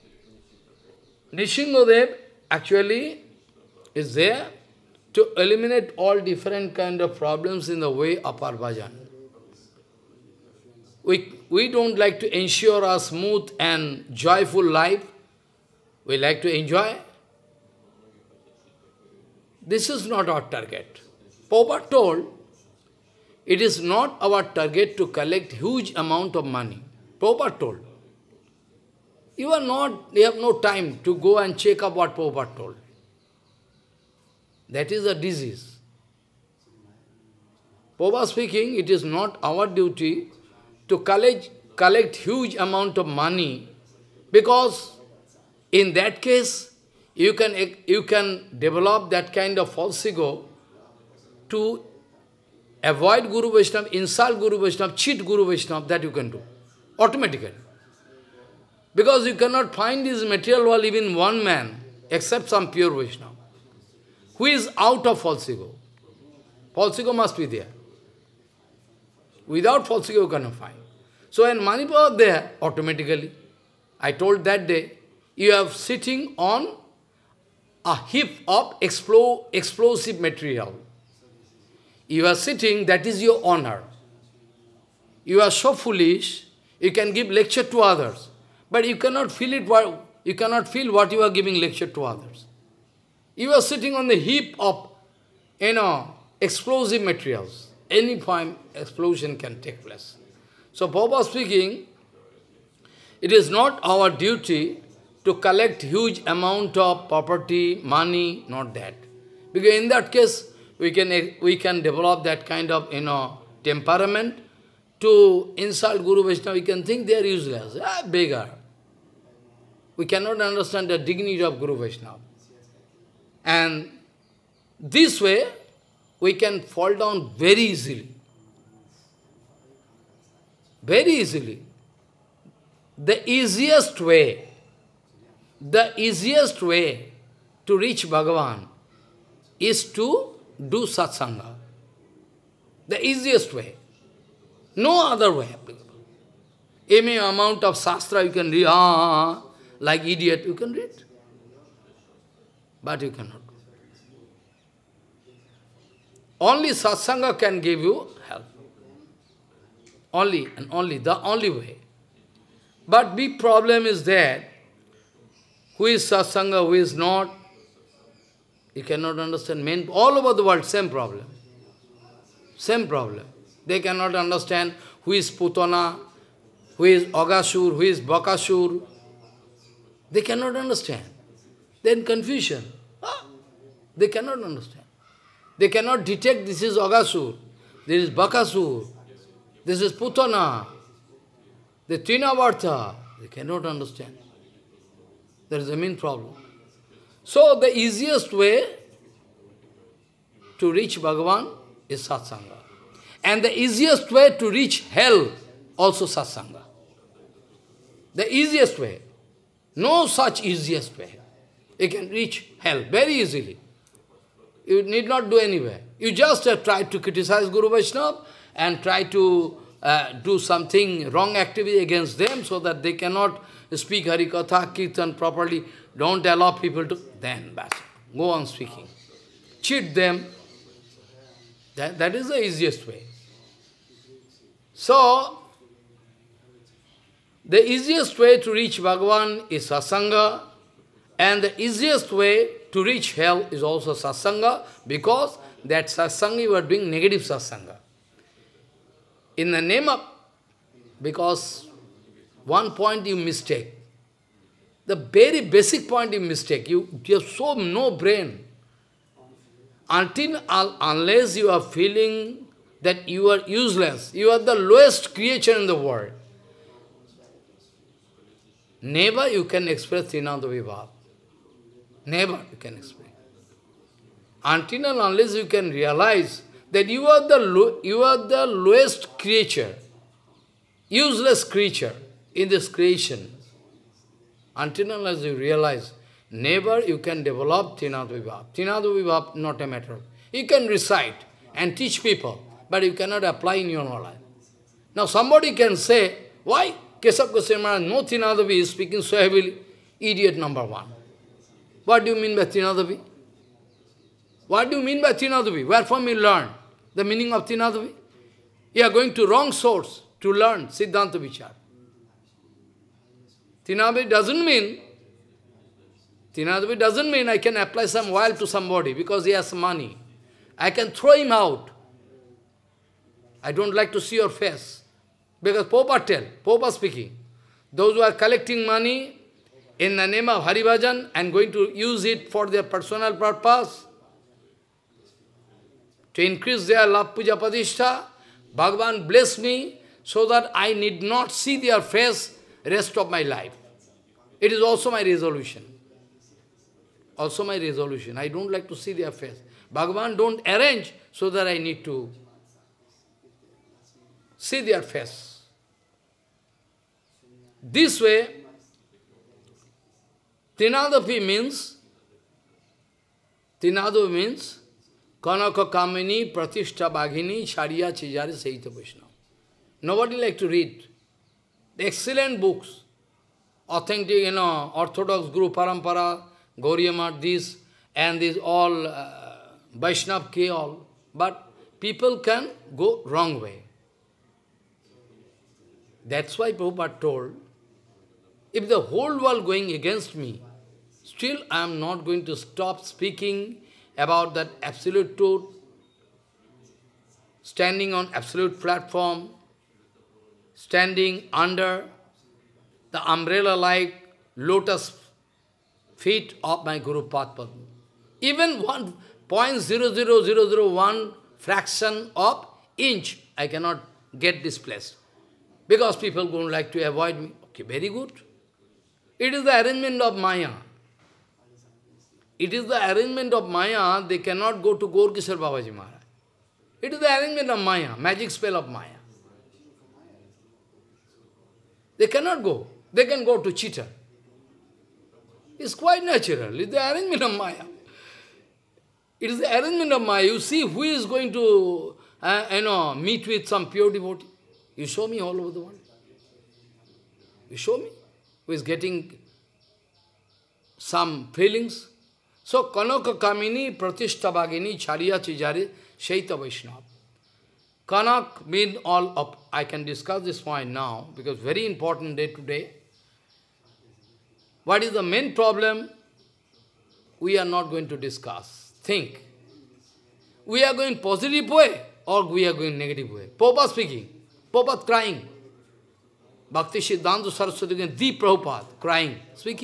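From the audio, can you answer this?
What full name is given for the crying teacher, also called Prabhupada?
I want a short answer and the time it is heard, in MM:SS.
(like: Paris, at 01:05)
Bhakti Siddhanta Saraswati, at 07:56.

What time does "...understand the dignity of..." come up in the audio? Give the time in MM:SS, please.
02:00.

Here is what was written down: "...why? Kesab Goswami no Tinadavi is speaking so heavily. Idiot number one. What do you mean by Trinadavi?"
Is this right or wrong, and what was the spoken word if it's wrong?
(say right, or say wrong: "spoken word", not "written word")
right.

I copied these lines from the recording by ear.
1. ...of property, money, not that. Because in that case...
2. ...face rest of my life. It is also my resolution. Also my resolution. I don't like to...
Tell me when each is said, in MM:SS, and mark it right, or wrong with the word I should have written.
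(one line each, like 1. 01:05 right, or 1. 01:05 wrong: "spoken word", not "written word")
1. 01:46 right
2. 05:41 right.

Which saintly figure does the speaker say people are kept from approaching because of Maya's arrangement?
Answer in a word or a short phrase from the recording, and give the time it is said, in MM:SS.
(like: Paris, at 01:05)
Gaur Kishor Babaji Maharaj, at 07:04.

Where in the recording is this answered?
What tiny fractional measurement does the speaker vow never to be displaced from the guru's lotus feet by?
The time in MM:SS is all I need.
06:48.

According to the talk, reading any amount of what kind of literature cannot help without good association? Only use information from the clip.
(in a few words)
sastra.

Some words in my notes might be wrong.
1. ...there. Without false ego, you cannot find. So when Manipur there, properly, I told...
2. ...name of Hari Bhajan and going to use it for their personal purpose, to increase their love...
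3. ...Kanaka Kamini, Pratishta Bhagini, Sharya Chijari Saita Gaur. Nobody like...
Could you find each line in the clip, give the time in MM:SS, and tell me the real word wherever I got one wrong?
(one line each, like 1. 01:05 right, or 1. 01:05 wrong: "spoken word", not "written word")
1. 01:07 wrong: "automatically", not "properly"
2. 05:30 right
3. 06:05 wrong: "Vaishnava", not "Gaur".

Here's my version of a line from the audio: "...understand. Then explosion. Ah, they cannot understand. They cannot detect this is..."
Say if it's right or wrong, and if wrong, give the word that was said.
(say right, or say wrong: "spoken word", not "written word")
wrong: "confusion", not "explosion".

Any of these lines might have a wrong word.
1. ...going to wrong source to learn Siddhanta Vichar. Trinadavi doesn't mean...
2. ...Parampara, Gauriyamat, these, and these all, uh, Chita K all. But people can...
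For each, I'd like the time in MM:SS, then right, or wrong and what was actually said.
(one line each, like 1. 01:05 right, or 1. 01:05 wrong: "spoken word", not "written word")
1. 05:08 right
2. 06:15 wrong: "Vaishnav", not "Chita".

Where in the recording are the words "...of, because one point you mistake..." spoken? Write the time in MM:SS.
04:09.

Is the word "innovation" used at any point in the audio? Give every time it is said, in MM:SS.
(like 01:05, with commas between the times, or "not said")
not said.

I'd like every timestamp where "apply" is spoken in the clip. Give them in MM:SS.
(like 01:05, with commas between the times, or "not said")
04:53, 05:17.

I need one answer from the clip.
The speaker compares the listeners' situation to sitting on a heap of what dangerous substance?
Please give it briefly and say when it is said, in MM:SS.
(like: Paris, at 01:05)
explosive material, at 01:18.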